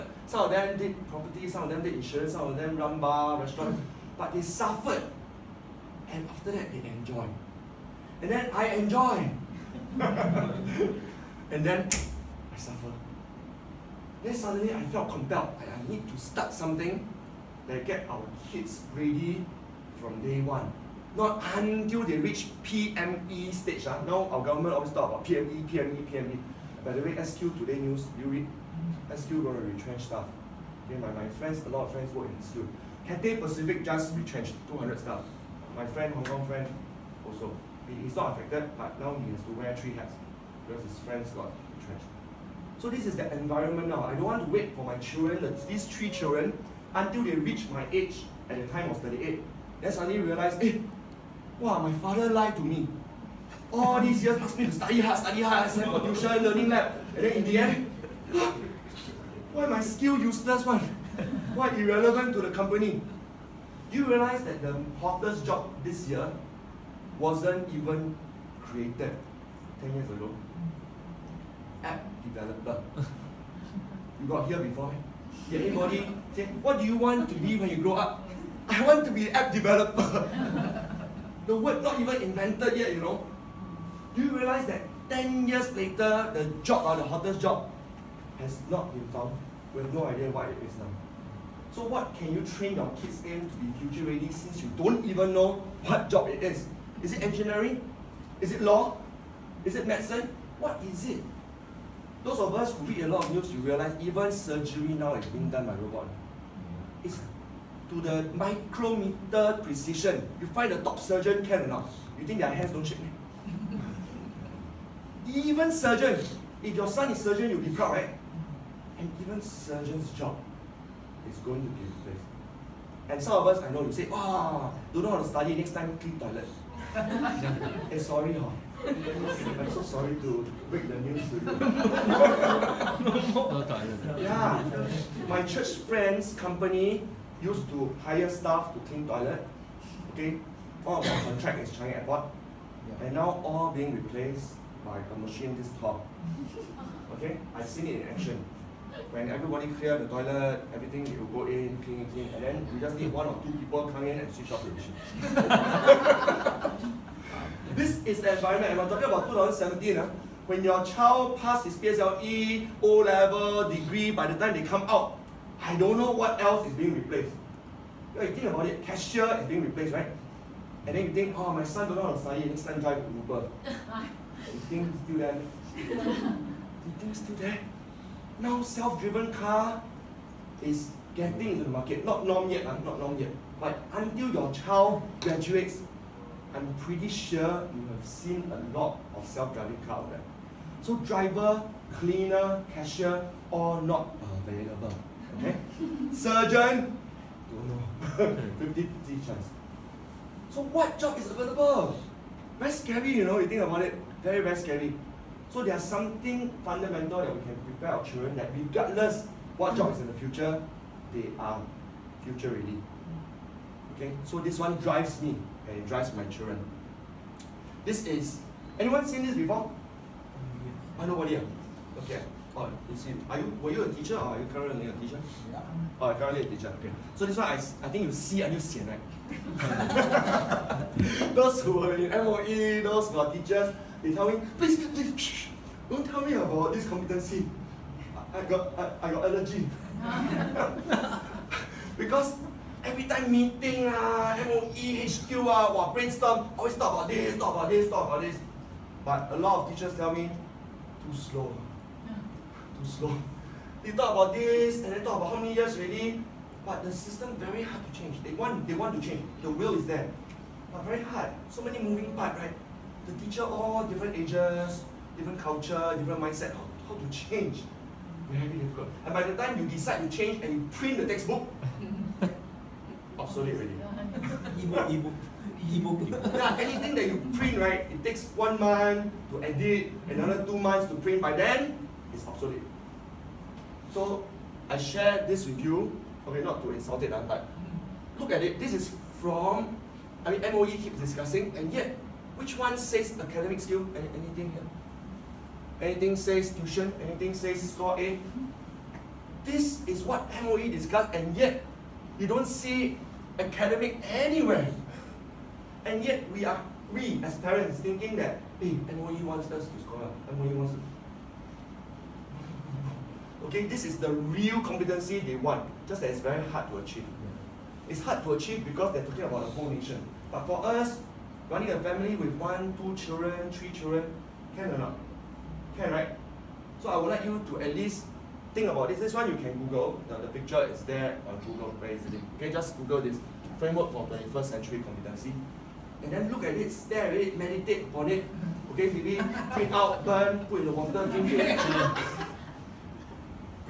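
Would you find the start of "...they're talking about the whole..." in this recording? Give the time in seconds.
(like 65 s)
318 s.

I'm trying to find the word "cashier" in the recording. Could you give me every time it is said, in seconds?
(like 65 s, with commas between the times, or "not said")
168 s, 192 s.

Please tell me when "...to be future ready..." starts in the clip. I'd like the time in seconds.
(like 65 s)
93 s.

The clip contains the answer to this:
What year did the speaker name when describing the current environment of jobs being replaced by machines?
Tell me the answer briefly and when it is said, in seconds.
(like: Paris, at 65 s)
2017, at 159 s.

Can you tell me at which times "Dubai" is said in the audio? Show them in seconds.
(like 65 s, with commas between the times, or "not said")
not said.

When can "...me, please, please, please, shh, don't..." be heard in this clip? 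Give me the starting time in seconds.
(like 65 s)
234 s.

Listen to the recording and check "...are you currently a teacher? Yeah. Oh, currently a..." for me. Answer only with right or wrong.
right.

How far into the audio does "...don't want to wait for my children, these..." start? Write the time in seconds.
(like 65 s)
44 s.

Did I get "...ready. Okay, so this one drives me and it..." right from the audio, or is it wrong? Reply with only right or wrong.
right.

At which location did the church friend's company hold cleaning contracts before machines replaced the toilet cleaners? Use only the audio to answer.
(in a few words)
Changi Airport.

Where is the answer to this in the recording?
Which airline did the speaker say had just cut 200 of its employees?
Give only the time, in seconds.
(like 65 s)
33 s.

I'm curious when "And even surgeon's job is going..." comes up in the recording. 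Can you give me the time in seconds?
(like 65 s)
118 s.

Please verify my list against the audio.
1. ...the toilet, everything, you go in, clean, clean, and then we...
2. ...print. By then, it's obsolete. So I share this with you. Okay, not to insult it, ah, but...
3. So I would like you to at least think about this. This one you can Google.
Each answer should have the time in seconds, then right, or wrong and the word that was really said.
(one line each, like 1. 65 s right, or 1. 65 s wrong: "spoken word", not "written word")
1. 149 s right
2. 281 s right
3. 326 s right.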